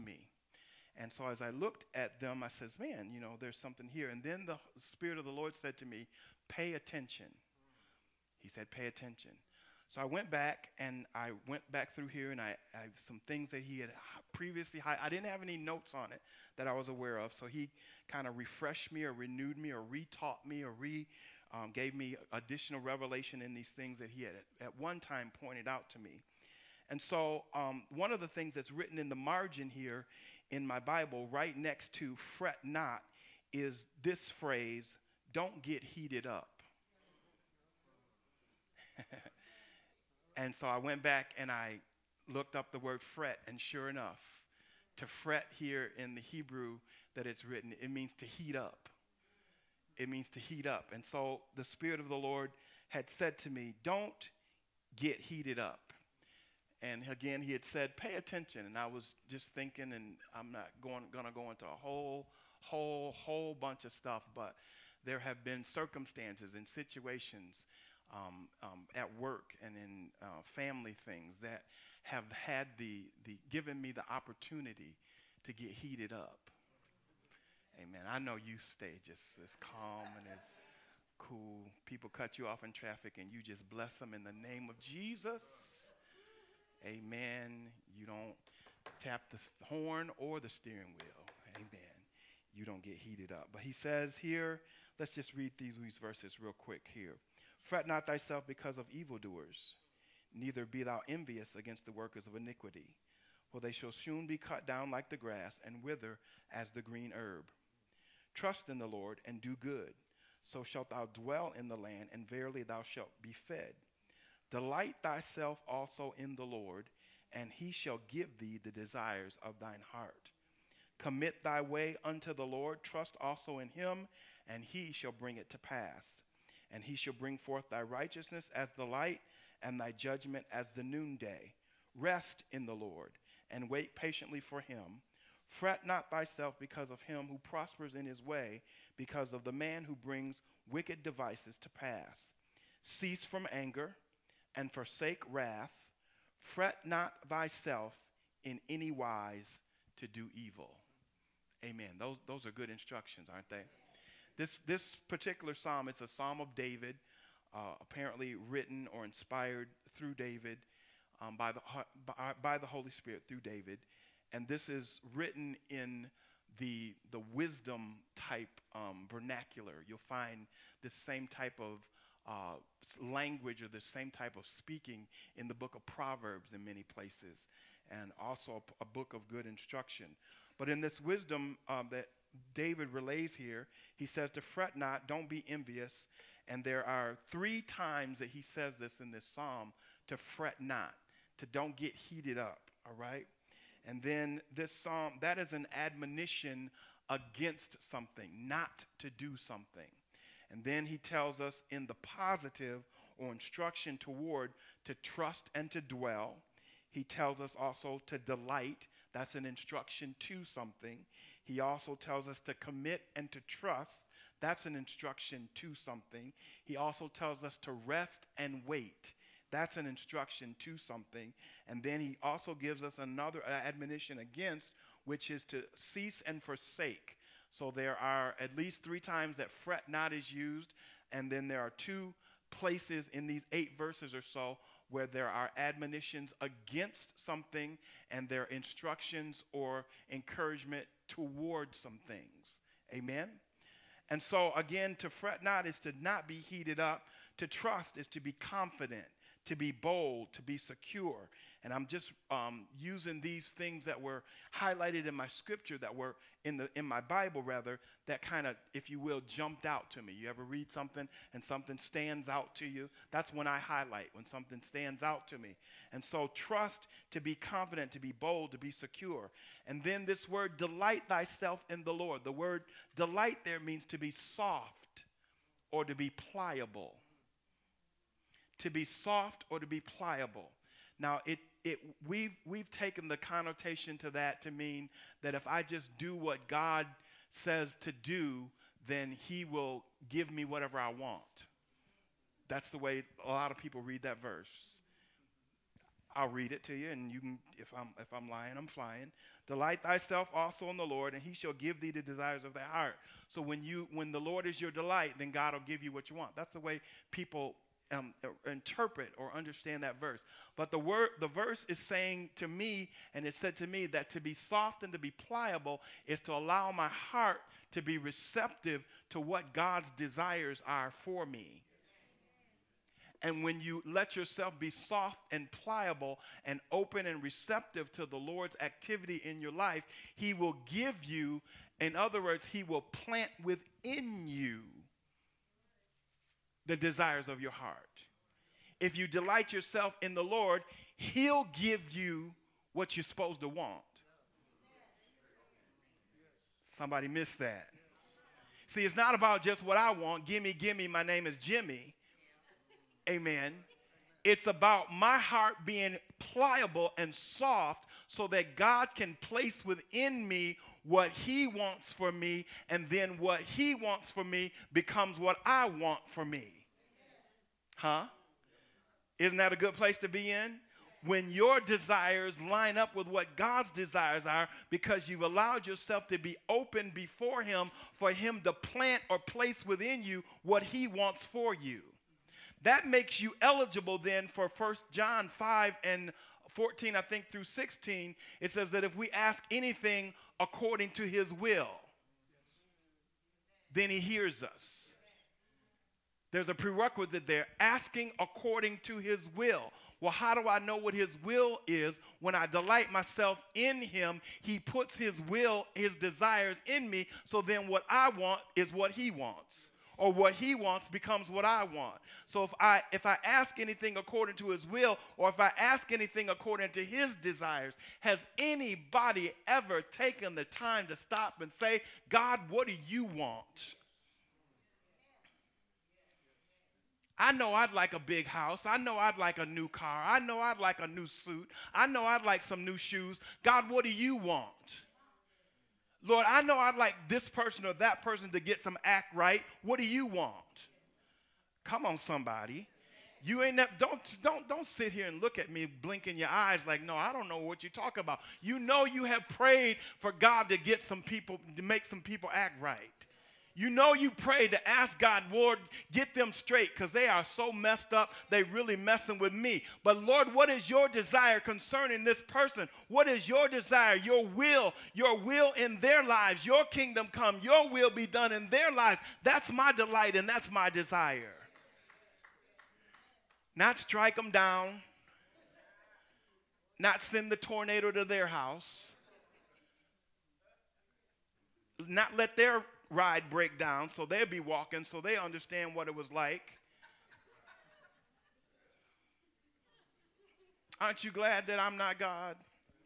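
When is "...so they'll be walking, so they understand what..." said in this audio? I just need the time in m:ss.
8:03.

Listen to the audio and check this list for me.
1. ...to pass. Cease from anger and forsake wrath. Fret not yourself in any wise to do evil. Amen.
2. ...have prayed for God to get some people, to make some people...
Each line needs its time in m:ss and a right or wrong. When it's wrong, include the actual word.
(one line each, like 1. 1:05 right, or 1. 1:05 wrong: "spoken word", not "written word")
1. 2:21 wrong: "thyself", not "yourself"
2. 7:29 right.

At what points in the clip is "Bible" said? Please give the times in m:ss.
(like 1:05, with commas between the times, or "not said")
0:30, 4:16.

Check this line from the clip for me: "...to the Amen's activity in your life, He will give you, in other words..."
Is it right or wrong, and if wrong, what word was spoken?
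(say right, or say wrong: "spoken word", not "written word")
wrong: "Lord", not "Amen".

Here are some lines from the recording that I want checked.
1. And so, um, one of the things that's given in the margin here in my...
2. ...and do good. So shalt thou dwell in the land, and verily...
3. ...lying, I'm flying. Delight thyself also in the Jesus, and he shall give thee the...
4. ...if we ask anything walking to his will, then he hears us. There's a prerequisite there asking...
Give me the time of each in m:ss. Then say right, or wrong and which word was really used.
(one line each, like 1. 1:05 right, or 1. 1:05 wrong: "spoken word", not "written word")
1. 0:26 wrong: "written", not "given"
2. 1:49 right
3. 4:58 wrong: "Lord", not "Jesus"
4. 6:28 wrong: "according", not "walking".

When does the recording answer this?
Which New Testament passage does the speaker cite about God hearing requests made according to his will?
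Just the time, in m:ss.
6:24.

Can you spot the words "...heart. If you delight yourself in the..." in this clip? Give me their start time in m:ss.
5:37.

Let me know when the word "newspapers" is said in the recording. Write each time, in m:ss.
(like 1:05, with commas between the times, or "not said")
not said.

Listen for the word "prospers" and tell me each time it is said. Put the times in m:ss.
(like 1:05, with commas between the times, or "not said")
2:17.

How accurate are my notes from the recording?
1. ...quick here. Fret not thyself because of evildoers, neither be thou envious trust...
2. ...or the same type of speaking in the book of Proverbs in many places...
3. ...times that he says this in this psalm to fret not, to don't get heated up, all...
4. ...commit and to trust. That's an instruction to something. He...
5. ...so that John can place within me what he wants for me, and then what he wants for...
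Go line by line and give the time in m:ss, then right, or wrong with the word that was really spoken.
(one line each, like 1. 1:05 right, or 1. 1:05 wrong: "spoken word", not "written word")
1. 1:36 wrong: "against", not "trust"
2. 2:53 right
3. 3:07 right
4. 3:32 right
5. 5:58 wrong: "God", not "John".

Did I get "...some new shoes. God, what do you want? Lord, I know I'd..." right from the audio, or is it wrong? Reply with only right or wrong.
right.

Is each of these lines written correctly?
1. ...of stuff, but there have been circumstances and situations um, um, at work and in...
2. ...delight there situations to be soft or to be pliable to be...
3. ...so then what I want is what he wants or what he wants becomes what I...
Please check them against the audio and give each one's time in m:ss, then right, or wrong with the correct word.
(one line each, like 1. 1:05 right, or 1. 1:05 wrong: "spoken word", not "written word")
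1. 1:03 right
2. 4:32 wrong: "means", not "situations"
3. 6:47 right.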